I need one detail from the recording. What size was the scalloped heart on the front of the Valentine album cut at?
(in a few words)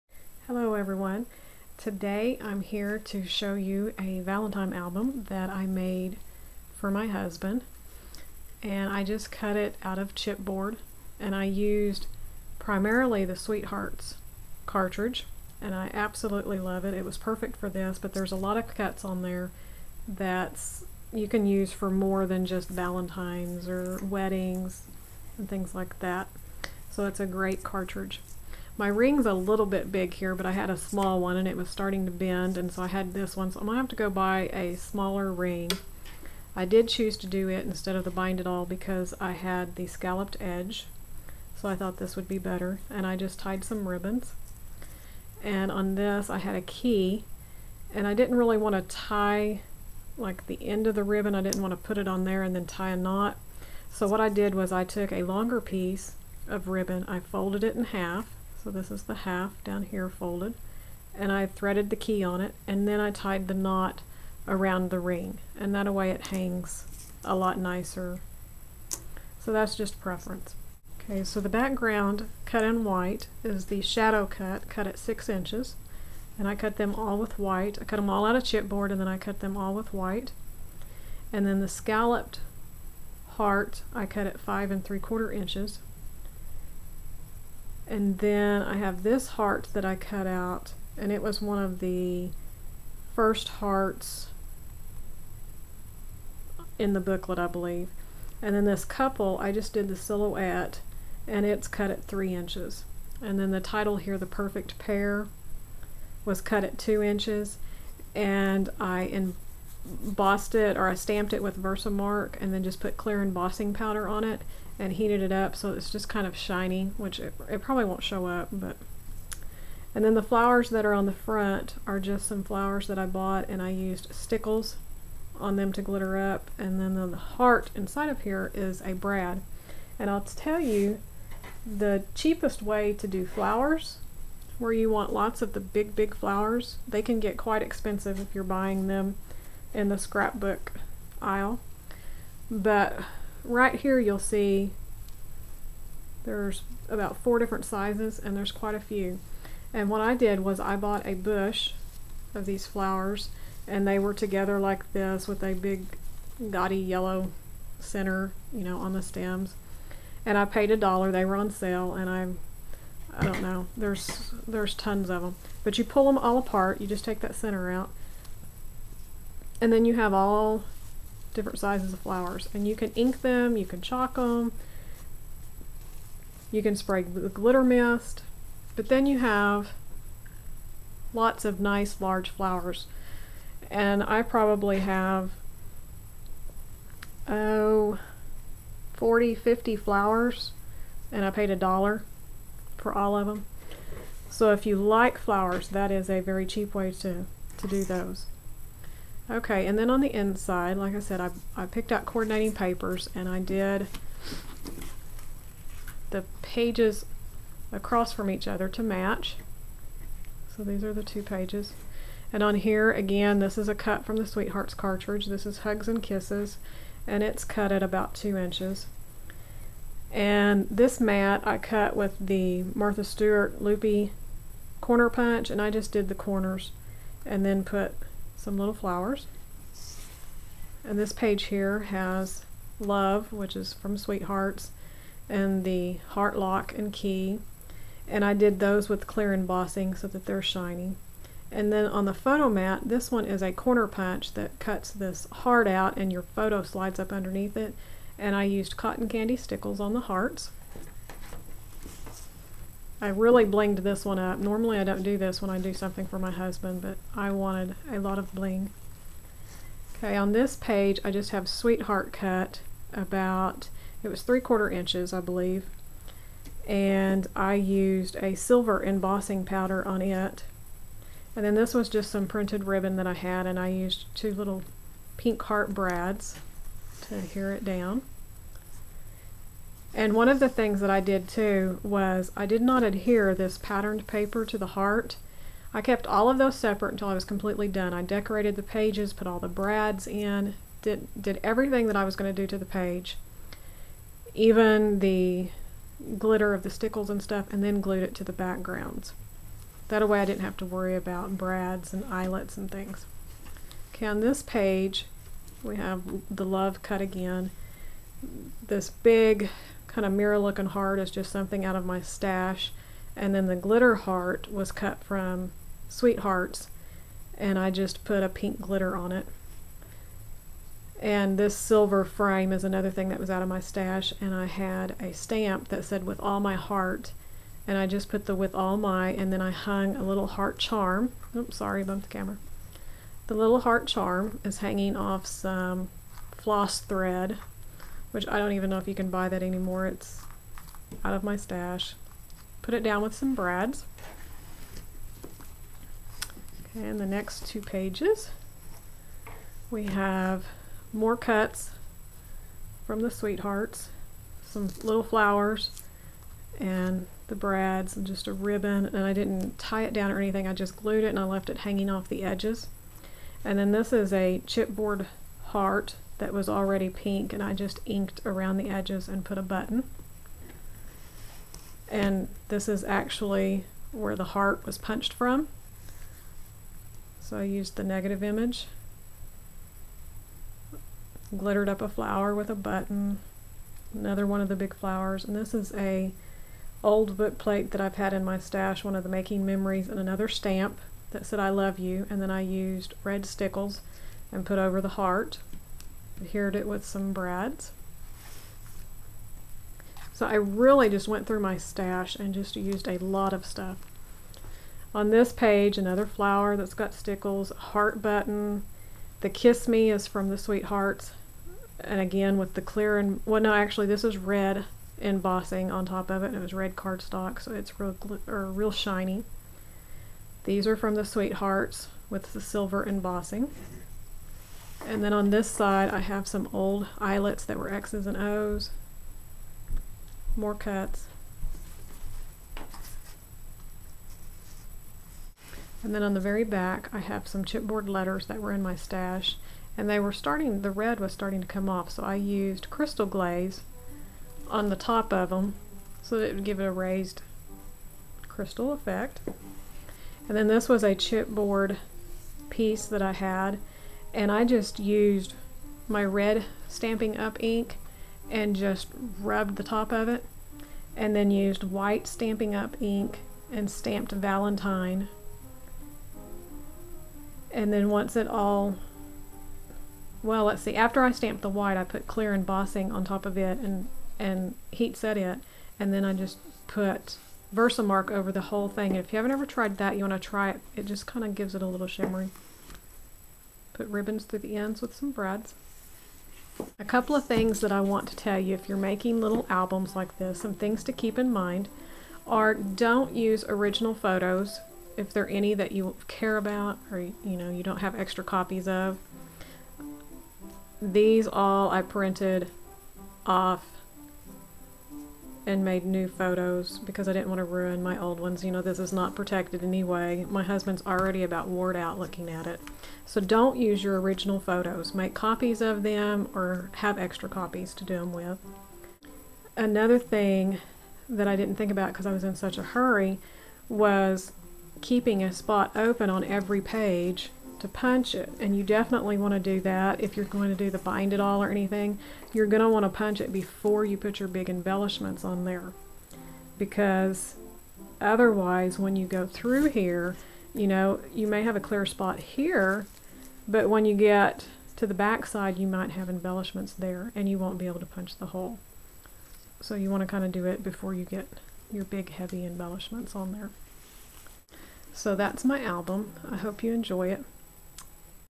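5 3/4 inches.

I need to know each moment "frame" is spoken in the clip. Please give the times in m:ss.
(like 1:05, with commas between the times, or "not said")
5:22.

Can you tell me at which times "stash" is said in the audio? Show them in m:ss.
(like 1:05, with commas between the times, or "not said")
5:12, 5:23, 5:41, 6:28, 6:41, 7:18.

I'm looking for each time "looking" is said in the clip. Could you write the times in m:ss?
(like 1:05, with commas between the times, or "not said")
5:10, 8:31.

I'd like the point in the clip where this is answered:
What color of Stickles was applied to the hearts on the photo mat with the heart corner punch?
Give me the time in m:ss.
4:08.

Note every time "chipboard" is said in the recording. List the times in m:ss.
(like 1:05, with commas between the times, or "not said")
0:10, 1:18, 6:04, 7:17, 7:30.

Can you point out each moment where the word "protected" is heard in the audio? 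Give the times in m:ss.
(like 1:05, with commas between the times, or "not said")
8:29.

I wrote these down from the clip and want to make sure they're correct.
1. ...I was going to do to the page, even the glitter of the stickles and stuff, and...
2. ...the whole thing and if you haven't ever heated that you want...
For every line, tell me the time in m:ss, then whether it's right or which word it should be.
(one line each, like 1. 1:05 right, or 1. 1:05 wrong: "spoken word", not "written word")
1. 4:51 right
2. 7:58 wrong: "tried", not "heated".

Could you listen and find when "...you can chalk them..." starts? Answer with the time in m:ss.
2:53.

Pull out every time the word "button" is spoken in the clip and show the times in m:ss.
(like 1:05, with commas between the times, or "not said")
6:09, 6:22, 6:48.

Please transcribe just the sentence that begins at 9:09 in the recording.
So you want to kind of do it before you get your big heavy embellishments on there.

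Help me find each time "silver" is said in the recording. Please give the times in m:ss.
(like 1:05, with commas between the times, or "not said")
4:28, 5:21, 7:02.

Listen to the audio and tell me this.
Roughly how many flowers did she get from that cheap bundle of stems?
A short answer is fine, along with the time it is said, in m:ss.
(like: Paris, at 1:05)
40 to 50, at 3:08.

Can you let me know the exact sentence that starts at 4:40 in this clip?
And one of the things that I did too was I did not adhere this patterned paper to the heart.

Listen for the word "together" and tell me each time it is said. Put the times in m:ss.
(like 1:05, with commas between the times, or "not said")
2:34.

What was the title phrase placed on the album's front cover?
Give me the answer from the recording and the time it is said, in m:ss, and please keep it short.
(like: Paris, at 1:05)
The Perfect Pair, at 1:44.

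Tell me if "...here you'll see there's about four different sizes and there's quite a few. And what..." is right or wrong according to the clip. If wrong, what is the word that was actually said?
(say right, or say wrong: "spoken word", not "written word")
right.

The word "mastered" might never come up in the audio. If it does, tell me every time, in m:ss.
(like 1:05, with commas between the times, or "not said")
not said.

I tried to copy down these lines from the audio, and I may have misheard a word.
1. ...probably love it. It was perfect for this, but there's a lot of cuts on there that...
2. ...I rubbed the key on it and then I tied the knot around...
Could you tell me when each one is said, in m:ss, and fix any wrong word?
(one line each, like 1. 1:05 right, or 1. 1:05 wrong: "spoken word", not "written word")
1. 0:15 wrong: "absolutely", not "probably"
2. 1:01 wrong: "threaded", not "rubbed".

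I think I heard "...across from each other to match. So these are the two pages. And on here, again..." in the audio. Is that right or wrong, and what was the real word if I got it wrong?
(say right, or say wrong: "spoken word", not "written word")
right.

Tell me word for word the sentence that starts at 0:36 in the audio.
I did choose to do it instead of the bind it all because I had the scalloped edge.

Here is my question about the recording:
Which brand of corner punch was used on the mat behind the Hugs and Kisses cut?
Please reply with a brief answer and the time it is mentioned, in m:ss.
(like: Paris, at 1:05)
Martha Stewart, at 3:42.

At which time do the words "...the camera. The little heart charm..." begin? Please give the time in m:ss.
5:32.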